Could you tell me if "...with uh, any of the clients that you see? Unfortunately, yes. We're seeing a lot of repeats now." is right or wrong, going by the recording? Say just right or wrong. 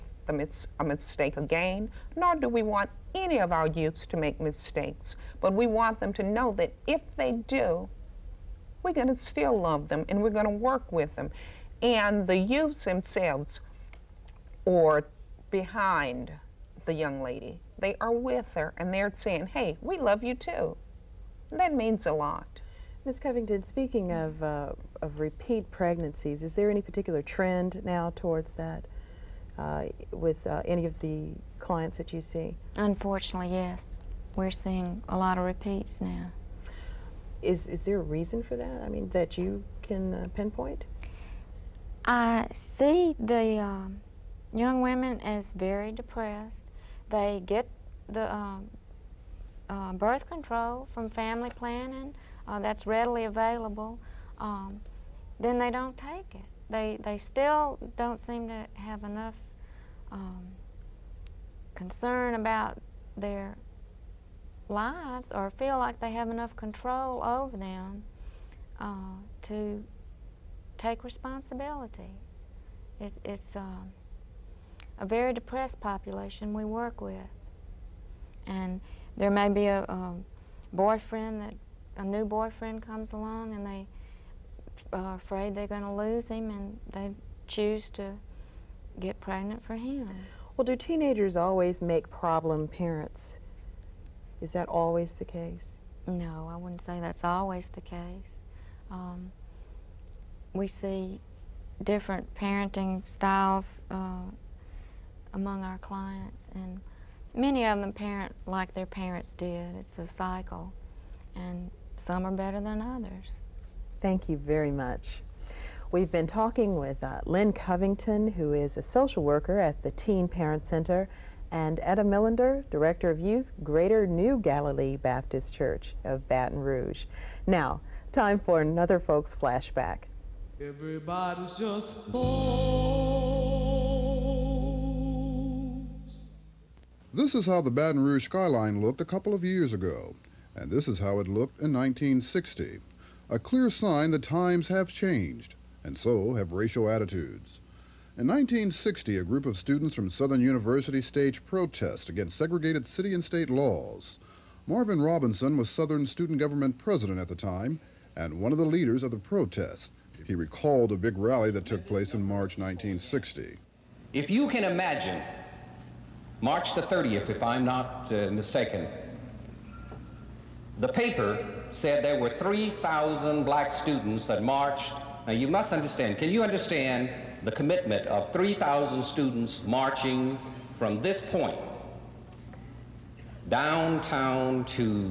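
right.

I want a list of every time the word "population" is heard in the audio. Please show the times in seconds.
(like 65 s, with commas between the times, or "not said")
75 s.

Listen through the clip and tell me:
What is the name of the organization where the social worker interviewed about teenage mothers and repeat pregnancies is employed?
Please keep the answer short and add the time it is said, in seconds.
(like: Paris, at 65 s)
Teen Parent Center, at 119 s.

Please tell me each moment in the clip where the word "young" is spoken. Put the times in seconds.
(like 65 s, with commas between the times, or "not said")
16 s, 44 s.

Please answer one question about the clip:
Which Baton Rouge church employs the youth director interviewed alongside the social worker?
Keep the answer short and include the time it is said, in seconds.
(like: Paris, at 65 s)
Greater New Galilee Baptist Church, at 123 s.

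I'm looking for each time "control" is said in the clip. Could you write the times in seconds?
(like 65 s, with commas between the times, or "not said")
50 s, 66 s.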